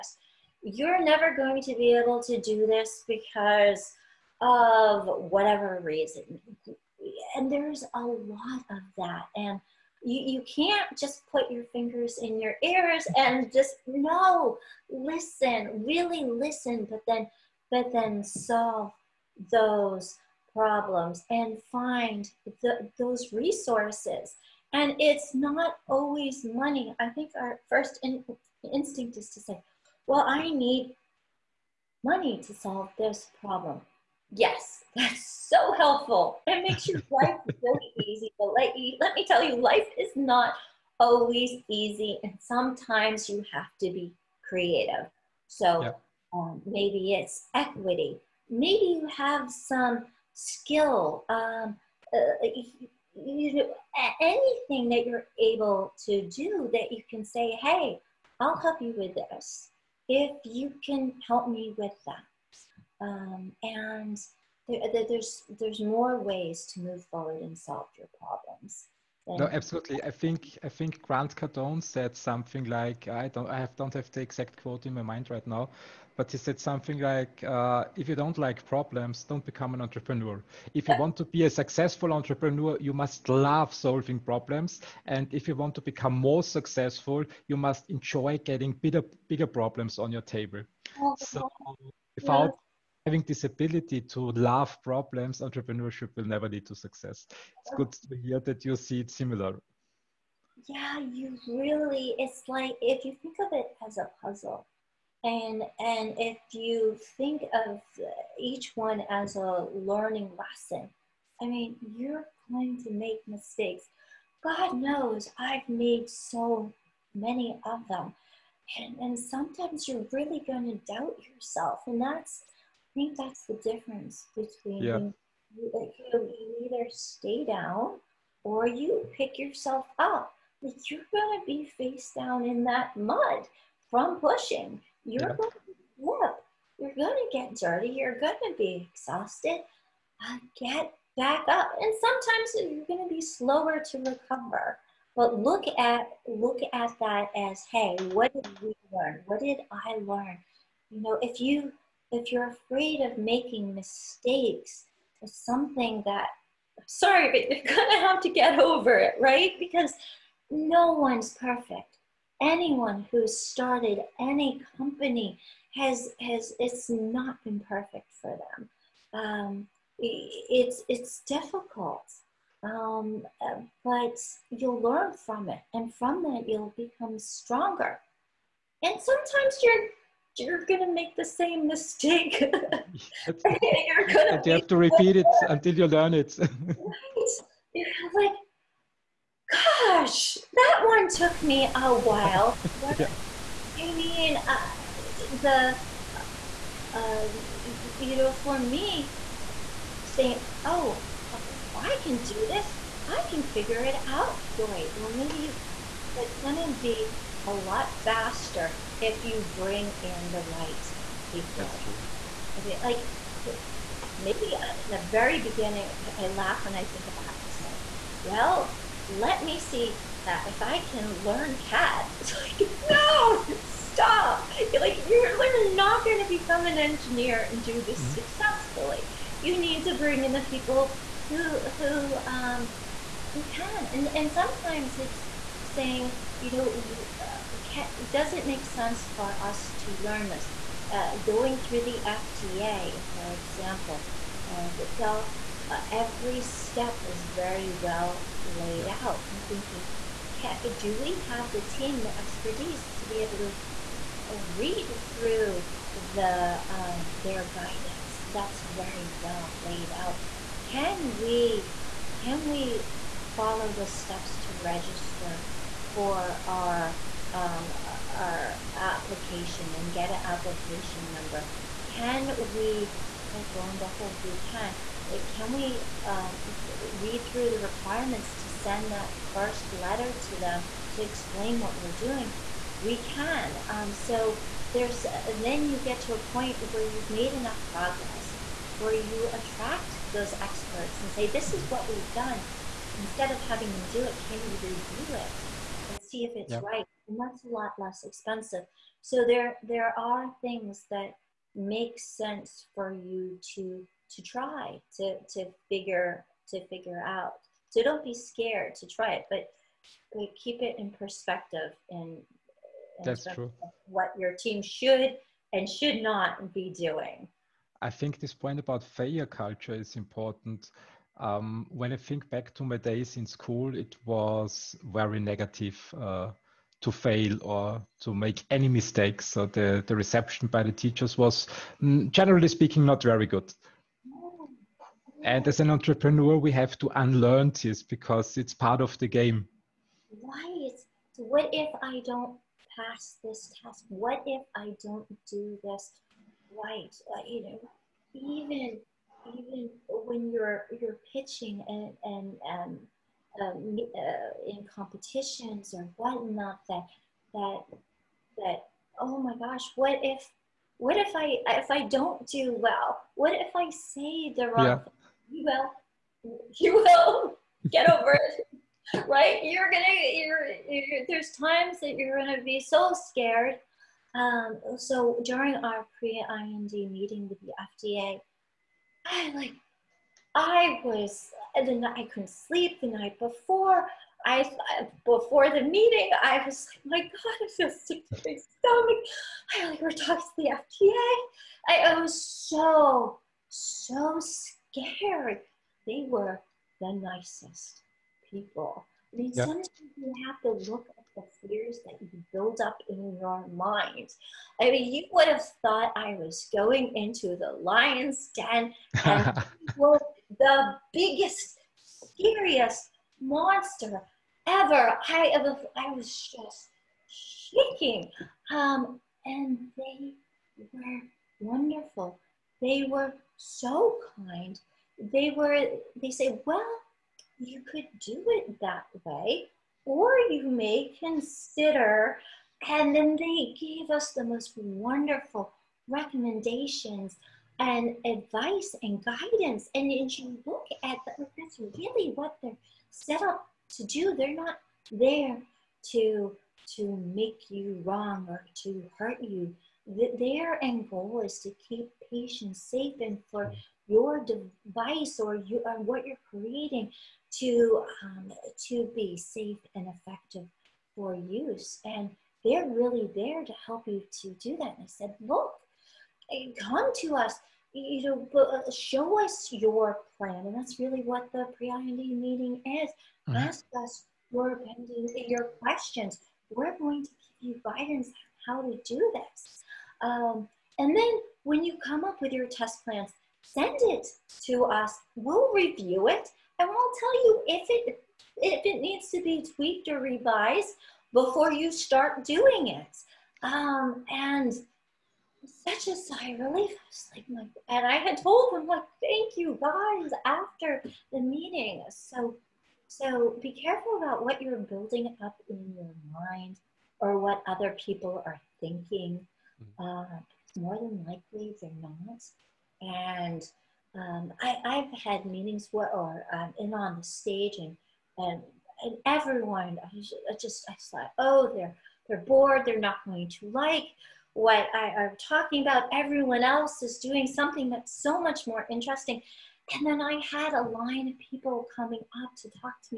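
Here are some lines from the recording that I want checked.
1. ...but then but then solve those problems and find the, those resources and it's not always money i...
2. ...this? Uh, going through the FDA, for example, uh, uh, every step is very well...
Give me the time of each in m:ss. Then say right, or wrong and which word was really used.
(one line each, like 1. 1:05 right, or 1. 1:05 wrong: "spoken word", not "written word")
1. 0:16 right
2. 4:00 right.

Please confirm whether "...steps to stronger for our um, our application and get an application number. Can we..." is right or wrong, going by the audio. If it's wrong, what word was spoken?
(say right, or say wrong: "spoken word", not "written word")
wrong: "register", not "stronger".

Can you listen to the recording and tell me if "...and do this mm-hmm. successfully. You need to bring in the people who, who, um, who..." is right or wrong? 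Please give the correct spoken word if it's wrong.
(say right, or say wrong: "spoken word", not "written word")
right.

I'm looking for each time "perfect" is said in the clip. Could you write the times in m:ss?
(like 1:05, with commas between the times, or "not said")
2:41, 2:47.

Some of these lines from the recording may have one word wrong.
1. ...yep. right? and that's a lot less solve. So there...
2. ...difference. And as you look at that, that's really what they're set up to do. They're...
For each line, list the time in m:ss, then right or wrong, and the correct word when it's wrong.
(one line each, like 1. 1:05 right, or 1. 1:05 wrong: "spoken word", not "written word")
1. 4:56 wrong: "expensive", not "solve"
2. 7:19 wrong: "guidance", not "difference".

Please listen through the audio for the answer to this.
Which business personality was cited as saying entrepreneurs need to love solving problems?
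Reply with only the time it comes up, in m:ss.
1:11.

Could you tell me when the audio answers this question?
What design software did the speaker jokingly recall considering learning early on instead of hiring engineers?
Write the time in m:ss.
3:41.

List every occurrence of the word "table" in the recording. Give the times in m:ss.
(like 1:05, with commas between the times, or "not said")
1:30.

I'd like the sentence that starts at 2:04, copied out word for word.
you, you either stay down or you pick yourself up.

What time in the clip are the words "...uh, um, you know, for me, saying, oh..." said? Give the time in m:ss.
3:16.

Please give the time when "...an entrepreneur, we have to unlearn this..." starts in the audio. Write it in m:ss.
5:35.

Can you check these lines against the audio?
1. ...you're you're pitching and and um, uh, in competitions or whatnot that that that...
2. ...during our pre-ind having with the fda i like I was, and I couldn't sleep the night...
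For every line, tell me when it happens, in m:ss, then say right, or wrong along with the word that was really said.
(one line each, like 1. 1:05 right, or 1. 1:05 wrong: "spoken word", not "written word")
1. 5:50 right
2. 6:15 wrong: "meeting", not "having".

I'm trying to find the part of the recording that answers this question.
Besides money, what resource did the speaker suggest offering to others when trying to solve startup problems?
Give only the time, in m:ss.
0:47.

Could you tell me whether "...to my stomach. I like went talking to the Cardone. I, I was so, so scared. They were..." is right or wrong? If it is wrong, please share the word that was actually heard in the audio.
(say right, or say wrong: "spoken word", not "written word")
wrong: "FDA", not "Cardone".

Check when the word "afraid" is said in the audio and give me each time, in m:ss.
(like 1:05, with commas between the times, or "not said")
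2:32.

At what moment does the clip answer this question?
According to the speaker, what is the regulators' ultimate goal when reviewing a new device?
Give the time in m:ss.
7:31.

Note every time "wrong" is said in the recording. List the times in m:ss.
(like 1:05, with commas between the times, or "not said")
6:04, 7:27.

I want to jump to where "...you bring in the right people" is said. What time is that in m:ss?
3:29.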